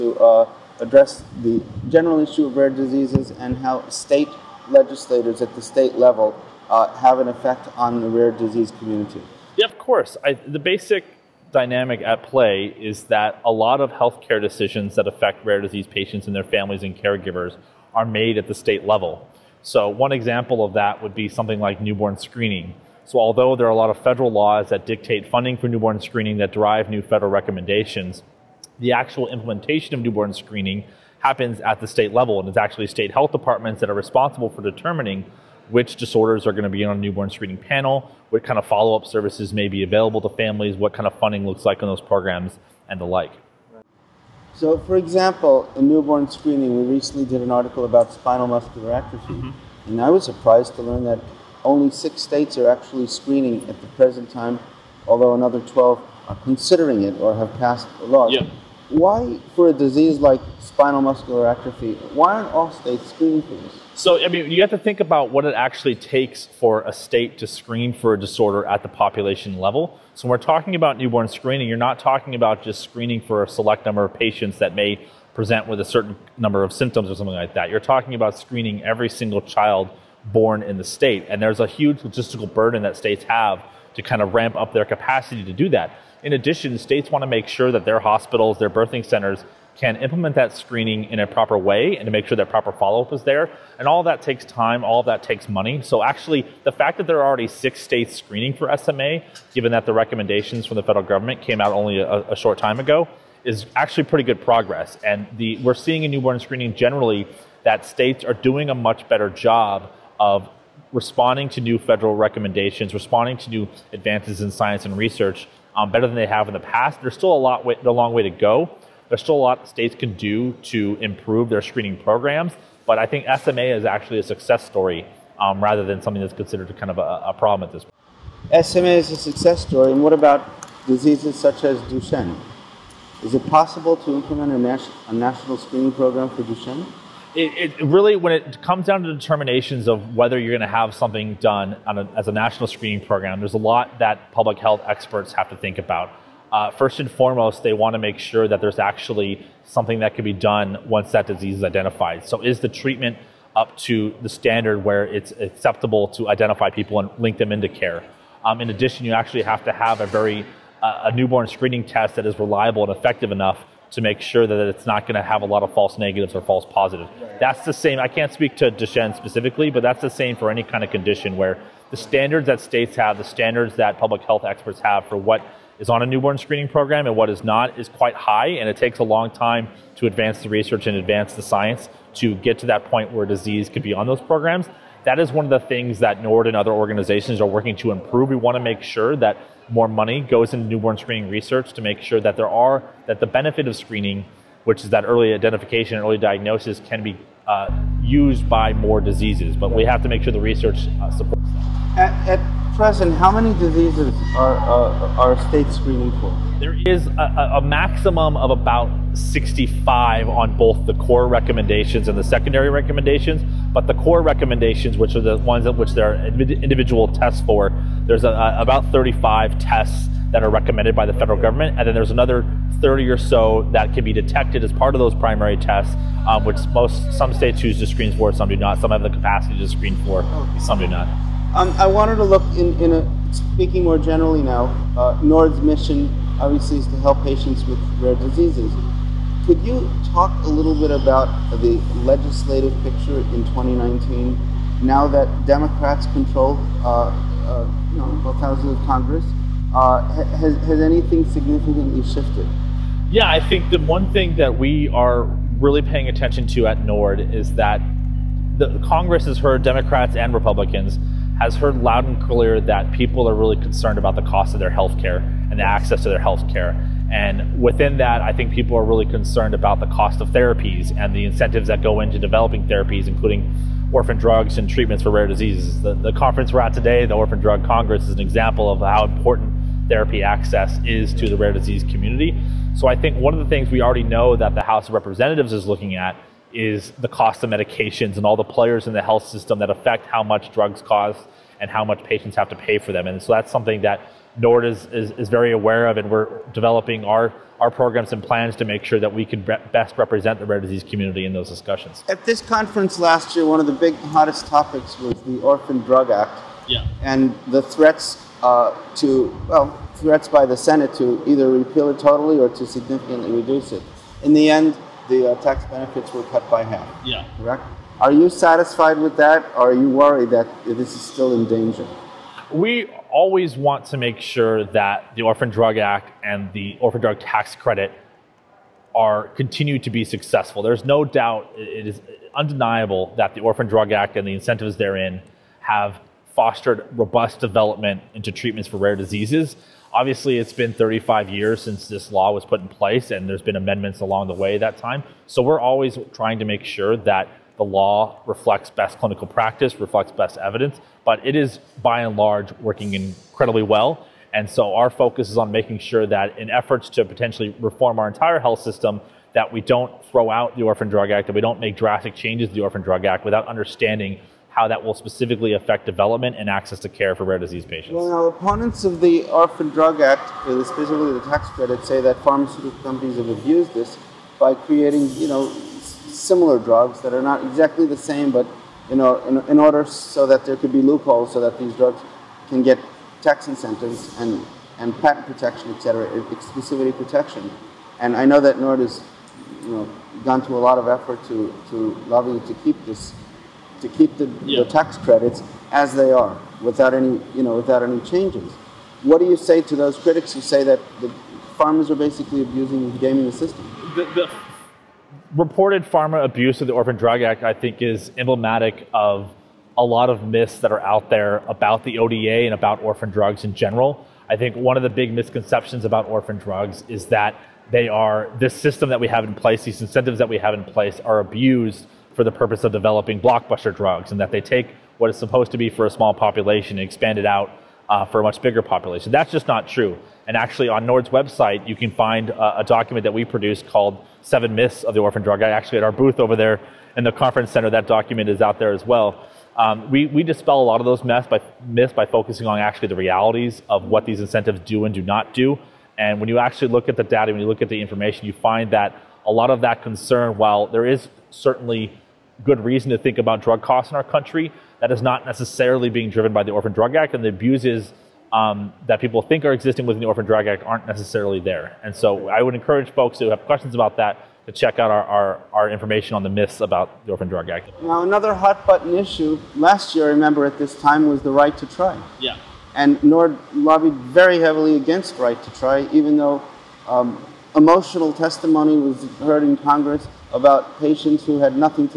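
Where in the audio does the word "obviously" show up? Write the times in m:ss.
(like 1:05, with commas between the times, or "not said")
3:56, 5:39.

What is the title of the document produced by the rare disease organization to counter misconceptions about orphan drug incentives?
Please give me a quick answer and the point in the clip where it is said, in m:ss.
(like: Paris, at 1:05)
Seven Myths of the Orphan Drug, at 7:14.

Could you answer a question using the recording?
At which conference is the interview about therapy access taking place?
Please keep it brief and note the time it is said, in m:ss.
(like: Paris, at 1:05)
Orphan Drug Congress, at 4:37.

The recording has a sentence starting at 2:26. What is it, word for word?
Uh, first and foremost, they want to make sure that there's actually something that can be done once that disease is identified.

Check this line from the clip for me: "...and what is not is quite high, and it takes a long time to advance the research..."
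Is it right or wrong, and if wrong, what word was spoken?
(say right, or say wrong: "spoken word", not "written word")
right.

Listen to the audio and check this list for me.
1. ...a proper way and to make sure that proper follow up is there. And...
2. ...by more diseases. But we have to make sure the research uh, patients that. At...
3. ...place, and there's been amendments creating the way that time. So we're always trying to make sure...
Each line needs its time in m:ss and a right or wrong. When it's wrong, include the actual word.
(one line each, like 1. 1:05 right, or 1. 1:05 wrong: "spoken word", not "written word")
1. 1:31 right
2. 3:18 wrong: "supports", not "patients"
3. 5:42 wrong: "along", not "creating".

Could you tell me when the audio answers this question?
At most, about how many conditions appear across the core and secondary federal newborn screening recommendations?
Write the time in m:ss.
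3:28.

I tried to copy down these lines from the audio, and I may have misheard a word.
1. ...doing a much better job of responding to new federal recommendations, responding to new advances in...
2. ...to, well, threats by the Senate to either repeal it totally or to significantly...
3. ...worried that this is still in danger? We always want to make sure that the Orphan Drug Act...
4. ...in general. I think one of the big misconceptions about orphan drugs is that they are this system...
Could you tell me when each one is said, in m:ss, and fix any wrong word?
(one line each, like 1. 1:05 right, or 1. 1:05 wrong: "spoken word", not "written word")
1. 1:48 right
2. 5:08 right
3. 5:19 right
4. 6:53 right.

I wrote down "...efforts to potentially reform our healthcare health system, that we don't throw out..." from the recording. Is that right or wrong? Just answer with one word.
wrong.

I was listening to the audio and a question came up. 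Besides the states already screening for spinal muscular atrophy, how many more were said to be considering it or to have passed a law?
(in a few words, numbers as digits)
12.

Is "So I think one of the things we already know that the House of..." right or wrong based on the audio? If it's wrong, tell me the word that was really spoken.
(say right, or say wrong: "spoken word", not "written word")
right.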